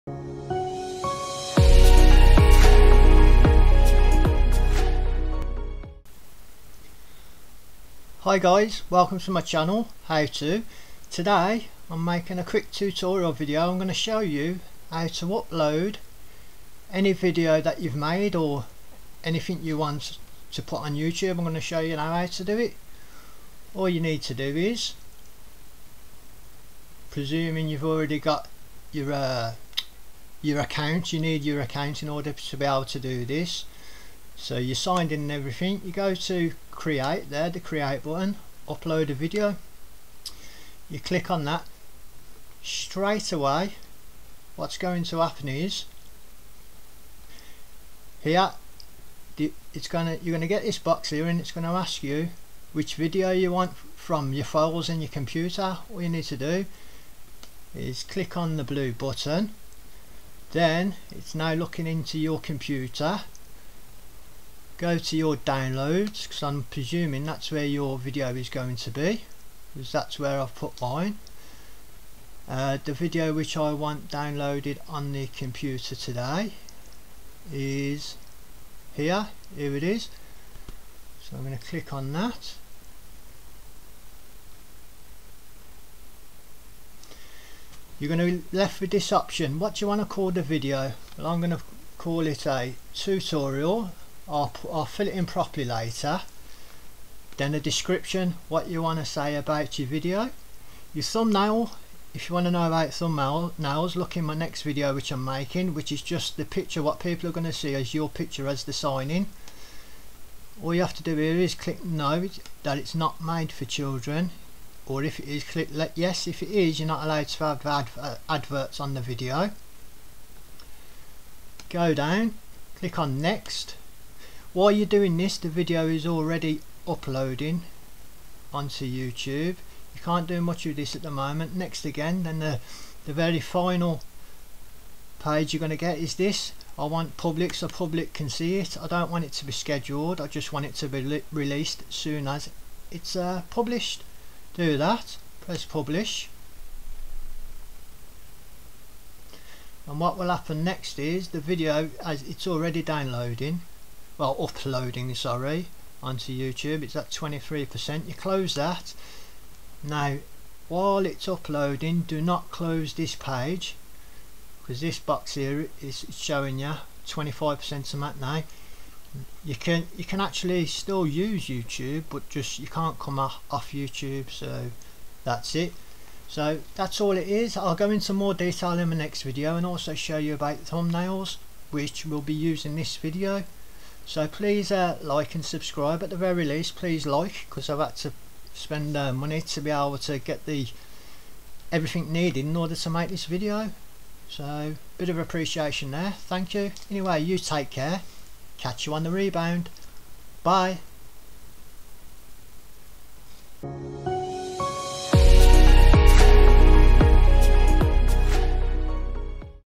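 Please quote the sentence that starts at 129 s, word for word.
You can't do much of this at the moment.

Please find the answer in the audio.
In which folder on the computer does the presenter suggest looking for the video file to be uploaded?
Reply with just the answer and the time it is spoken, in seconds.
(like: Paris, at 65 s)
Downloads, at 65 s.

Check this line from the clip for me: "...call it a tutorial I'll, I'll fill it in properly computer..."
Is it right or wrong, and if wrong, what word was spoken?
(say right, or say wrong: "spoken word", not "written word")
wrong: "later", not "computer".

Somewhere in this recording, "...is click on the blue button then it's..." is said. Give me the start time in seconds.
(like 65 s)
57 s.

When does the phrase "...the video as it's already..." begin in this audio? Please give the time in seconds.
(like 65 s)
151 s.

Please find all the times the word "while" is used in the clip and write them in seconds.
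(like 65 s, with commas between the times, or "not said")
124 s, 160 s.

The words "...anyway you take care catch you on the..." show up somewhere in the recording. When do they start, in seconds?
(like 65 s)
196 s.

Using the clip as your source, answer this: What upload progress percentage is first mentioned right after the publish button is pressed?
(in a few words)
23%.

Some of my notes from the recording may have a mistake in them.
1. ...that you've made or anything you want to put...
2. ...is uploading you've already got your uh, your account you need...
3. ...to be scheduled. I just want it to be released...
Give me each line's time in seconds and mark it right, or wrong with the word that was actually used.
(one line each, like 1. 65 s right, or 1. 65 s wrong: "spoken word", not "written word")
1. 17 s right
2. 24 s wrong: "presuming", not "uploading"
3. 139 s right.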